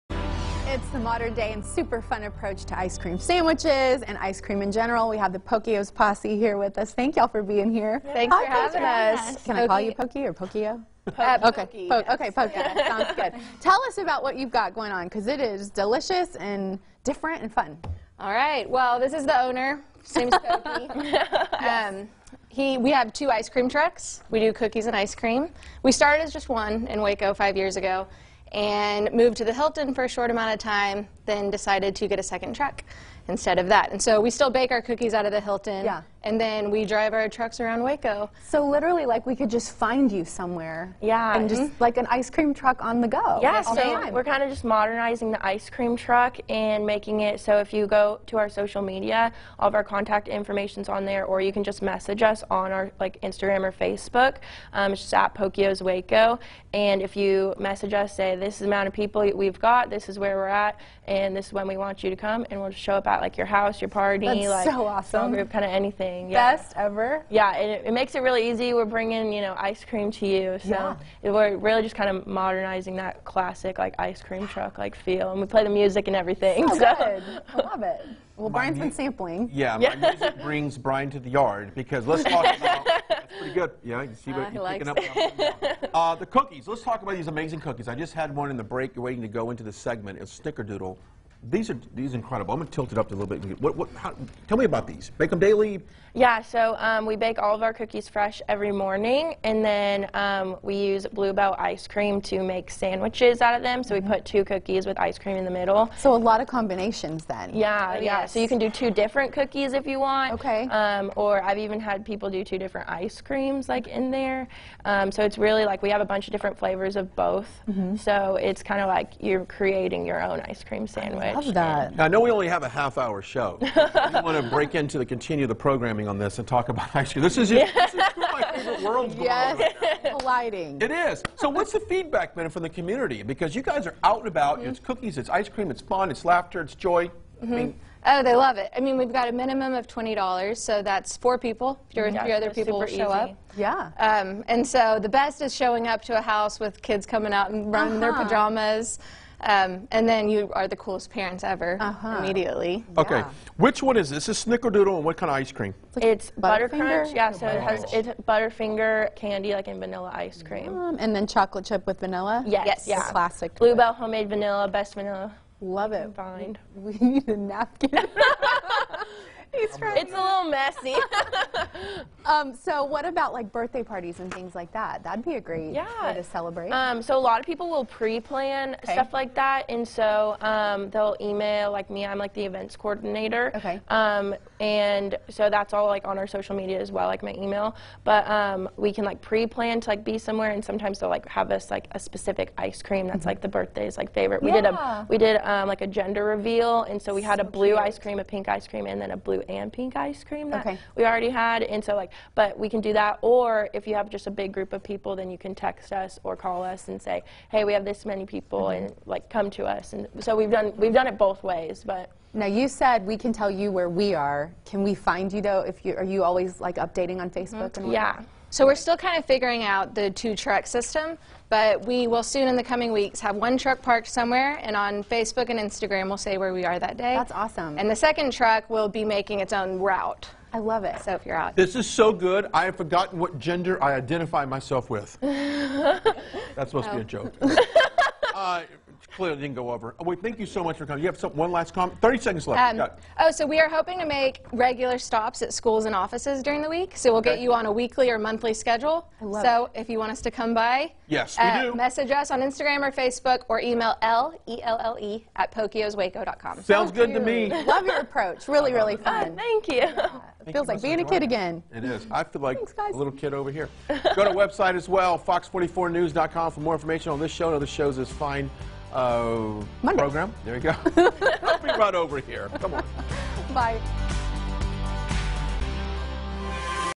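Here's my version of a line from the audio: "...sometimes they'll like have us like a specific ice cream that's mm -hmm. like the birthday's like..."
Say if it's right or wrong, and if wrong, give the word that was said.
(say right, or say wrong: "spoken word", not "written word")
right.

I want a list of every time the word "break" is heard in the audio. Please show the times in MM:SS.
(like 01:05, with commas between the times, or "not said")
01:28, 02:04.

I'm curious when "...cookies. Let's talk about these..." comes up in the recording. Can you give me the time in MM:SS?
01:26.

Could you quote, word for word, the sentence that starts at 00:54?
Um, it's just at Pokios Waco.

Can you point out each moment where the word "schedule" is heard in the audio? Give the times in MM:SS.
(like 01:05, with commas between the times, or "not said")
04:08.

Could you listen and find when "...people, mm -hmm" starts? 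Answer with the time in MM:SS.
03:28.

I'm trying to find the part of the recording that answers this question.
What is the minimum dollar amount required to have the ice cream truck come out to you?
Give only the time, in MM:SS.
02:19.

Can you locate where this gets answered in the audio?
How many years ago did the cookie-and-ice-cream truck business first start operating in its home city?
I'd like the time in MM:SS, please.
00:27.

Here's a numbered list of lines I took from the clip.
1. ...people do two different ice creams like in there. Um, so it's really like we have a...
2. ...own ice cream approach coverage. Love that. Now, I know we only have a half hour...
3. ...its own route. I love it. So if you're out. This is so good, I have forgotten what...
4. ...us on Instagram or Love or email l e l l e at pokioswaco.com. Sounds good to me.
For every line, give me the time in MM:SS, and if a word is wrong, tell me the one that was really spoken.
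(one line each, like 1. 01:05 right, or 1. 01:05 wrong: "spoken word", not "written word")
1. 01:52 right
2. 02:00 wrong: "sandwich", not "approach"
3. 03:49 right
4. 04:12 wrong: "Facebook", not "Love".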